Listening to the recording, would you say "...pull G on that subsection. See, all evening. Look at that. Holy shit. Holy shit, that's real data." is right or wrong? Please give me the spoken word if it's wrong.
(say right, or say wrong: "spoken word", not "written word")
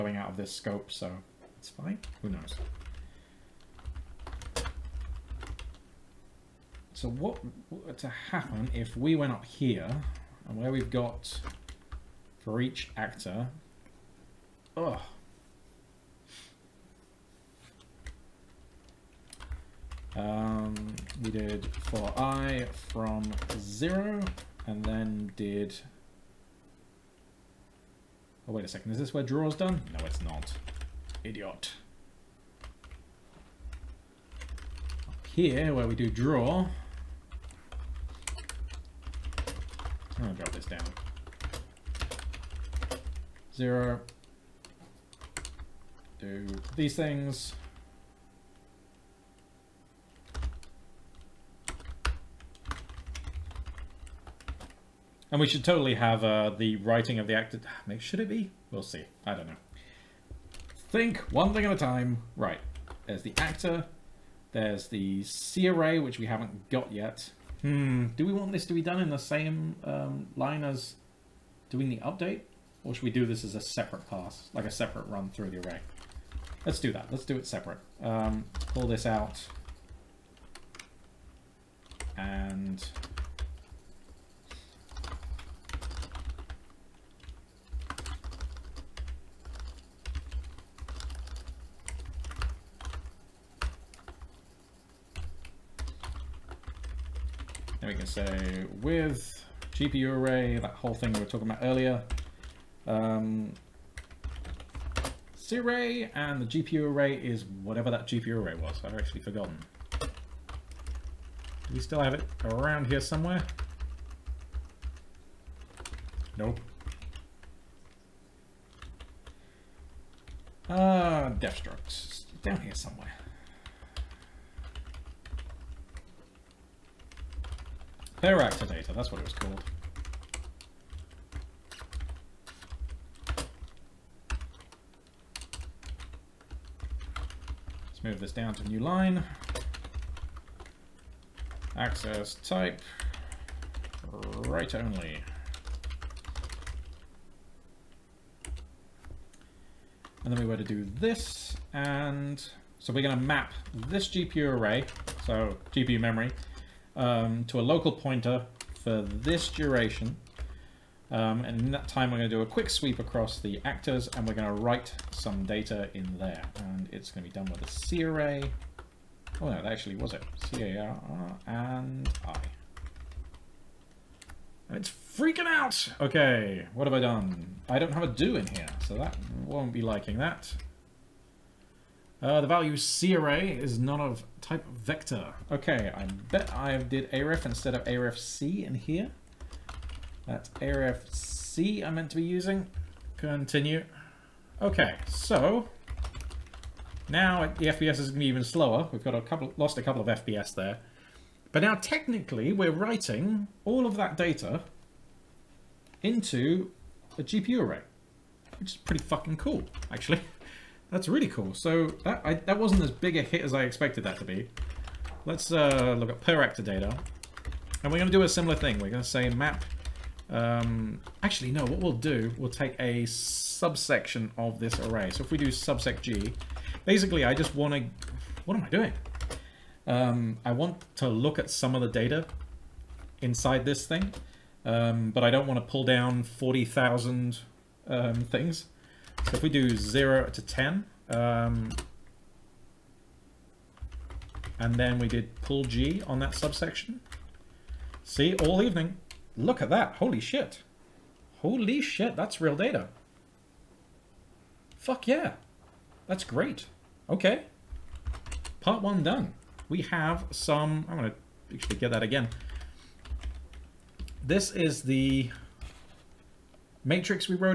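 right.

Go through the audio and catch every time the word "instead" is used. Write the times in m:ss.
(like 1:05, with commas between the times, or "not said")
3:07.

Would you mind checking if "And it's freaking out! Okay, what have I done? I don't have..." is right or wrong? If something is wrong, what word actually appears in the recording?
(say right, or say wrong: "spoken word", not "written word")
right.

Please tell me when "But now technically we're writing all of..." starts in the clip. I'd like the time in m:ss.
3:21.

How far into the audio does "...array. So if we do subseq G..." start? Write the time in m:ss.
3:44.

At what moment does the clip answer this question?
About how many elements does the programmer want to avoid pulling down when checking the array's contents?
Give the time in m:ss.
3:56.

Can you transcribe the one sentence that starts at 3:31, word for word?
So that I, that wasn't as big a hit as I expected that to be.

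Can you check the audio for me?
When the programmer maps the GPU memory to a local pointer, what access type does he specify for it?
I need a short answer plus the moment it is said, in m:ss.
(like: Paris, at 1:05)
write only, at 2:24.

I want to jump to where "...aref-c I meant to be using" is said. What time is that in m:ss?
3:10.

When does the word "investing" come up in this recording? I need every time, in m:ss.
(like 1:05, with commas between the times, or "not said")
not said.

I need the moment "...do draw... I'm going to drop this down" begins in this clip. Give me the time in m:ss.
0:35.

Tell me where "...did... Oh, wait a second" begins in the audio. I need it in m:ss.
0:25.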